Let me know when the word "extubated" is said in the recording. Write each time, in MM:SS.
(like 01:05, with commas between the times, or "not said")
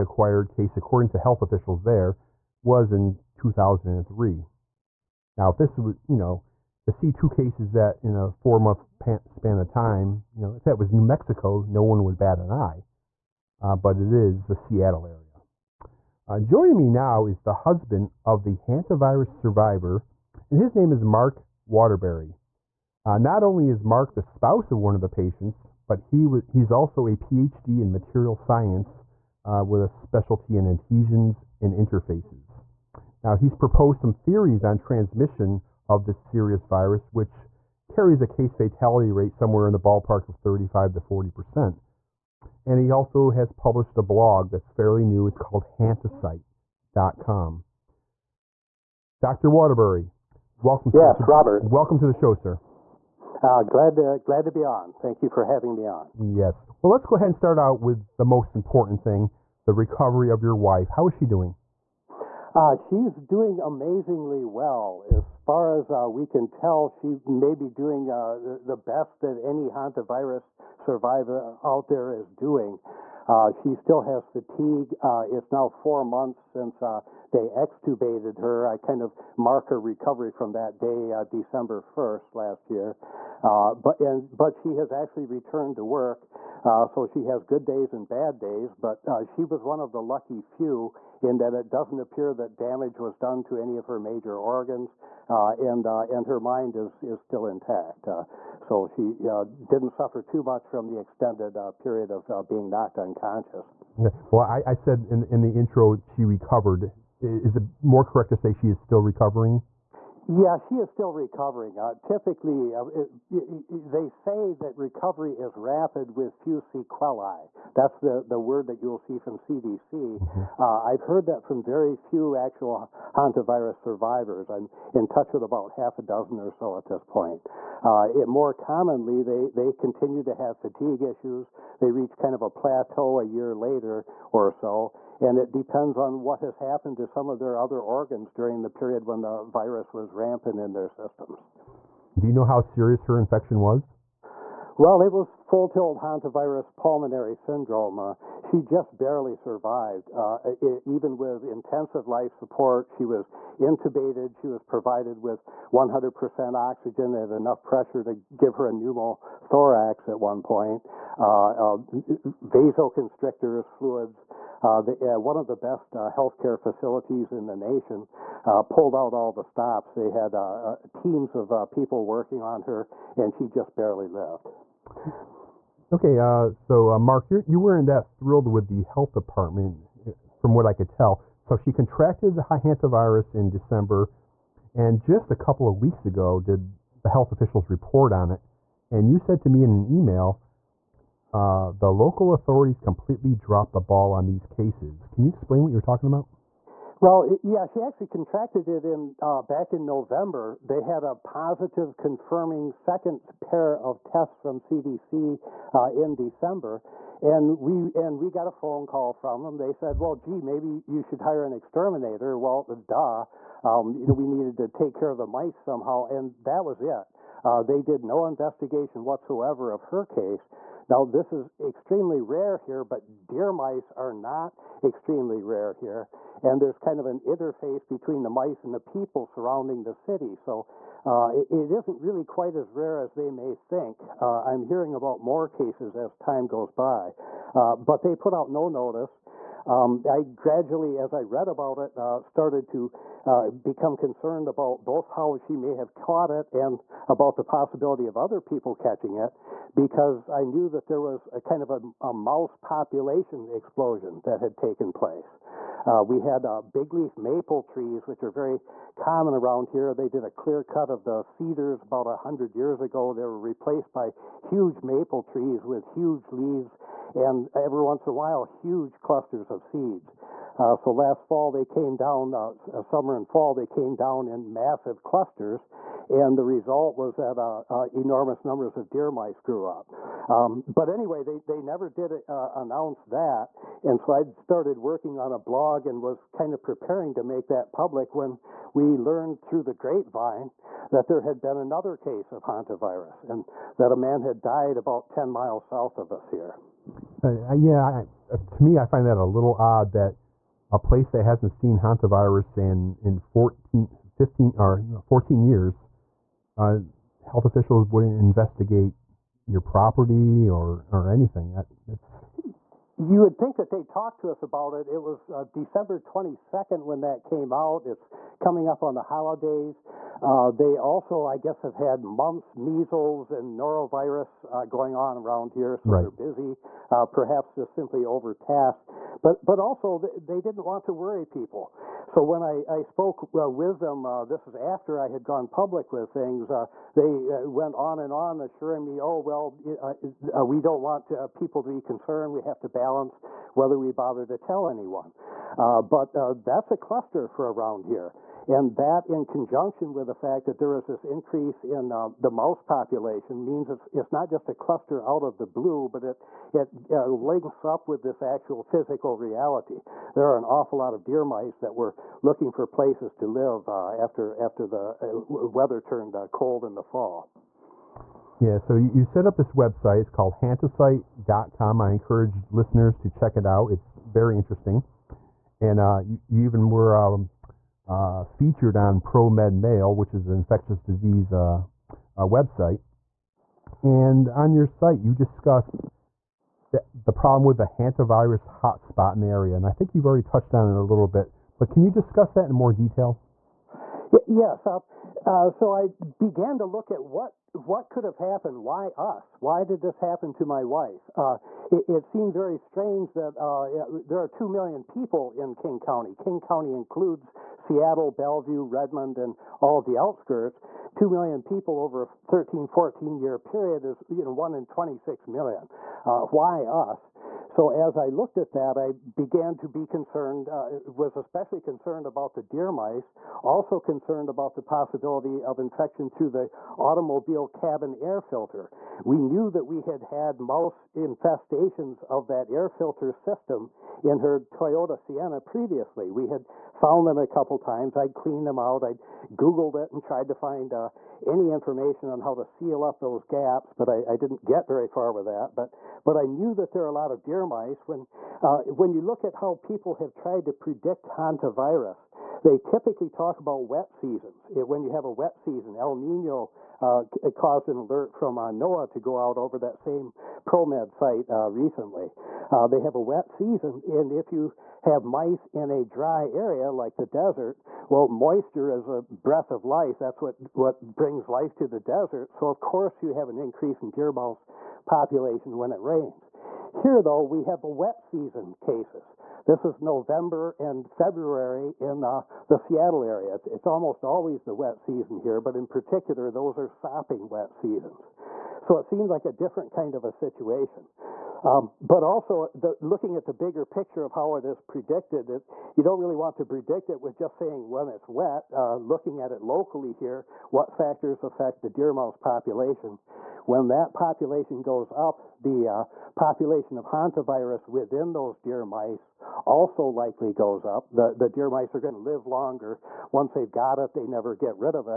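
01:17.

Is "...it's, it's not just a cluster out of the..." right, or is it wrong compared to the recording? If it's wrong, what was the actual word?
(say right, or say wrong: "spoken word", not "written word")
right.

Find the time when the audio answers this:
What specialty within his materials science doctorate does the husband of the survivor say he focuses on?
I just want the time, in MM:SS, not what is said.
00:30.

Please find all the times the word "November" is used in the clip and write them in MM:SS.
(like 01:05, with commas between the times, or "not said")
03:19, 07:59.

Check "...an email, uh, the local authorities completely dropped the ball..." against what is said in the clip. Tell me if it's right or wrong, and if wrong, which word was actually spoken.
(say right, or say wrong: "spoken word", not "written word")
right.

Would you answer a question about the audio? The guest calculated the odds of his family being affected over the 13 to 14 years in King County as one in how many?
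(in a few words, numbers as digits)
1 in 26 million.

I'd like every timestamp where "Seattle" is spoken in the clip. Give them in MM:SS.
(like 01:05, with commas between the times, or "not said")
00:14, 06:47, 08:02.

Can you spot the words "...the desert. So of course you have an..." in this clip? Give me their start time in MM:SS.
07:51.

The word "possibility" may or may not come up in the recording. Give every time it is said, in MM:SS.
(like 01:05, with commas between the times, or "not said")
04:07, 07:04.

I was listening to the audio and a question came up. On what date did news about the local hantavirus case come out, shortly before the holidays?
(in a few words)
December 22.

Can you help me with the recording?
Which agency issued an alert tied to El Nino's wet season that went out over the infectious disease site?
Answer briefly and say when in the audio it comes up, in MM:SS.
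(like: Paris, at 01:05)
NOAA, at 07:38.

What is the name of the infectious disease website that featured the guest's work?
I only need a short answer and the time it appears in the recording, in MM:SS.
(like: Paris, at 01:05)
ProMed Mail, at 06:19.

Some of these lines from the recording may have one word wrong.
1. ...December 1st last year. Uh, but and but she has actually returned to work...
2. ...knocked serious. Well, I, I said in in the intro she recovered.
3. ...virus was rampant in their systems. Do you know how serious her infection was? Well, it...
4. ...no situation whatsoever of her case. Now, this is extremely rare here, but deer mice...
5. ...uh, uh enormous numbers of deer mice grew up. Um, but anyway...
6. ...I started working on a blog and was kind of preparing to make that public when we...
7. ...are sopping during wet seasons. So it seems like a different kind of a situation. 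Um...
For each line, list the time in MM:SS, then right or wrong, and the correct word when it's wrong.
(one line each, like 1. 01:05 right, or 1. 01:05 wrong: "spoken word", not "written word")
1. 01:21 right
2. 01:42 wrong: "unconscious", not "serious"
3. 02:19 right
4. 03:38 wrong: "investigation", not "situation"
5. 04:37 right
6. 04:44 right
7. 08:06 right.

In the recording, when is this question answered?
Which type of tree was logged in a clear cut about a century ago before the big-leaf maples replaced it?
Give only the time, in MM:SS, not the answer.
04:21.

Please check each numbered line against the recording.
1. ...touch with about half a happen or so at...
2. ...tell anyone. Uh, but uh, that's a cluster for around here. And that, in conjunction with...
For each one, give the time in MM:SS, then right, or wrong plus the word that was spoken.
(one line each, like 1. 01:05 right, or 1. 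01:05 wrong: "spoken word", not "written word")
1. 02:05 wrong: "dozen", not "happen"
2. 05:44 right.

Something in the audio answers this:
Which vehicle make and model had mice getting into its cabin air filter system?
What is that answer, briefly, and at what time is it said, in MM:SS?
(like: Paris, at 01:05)
Toyota Sienna, at 07:14.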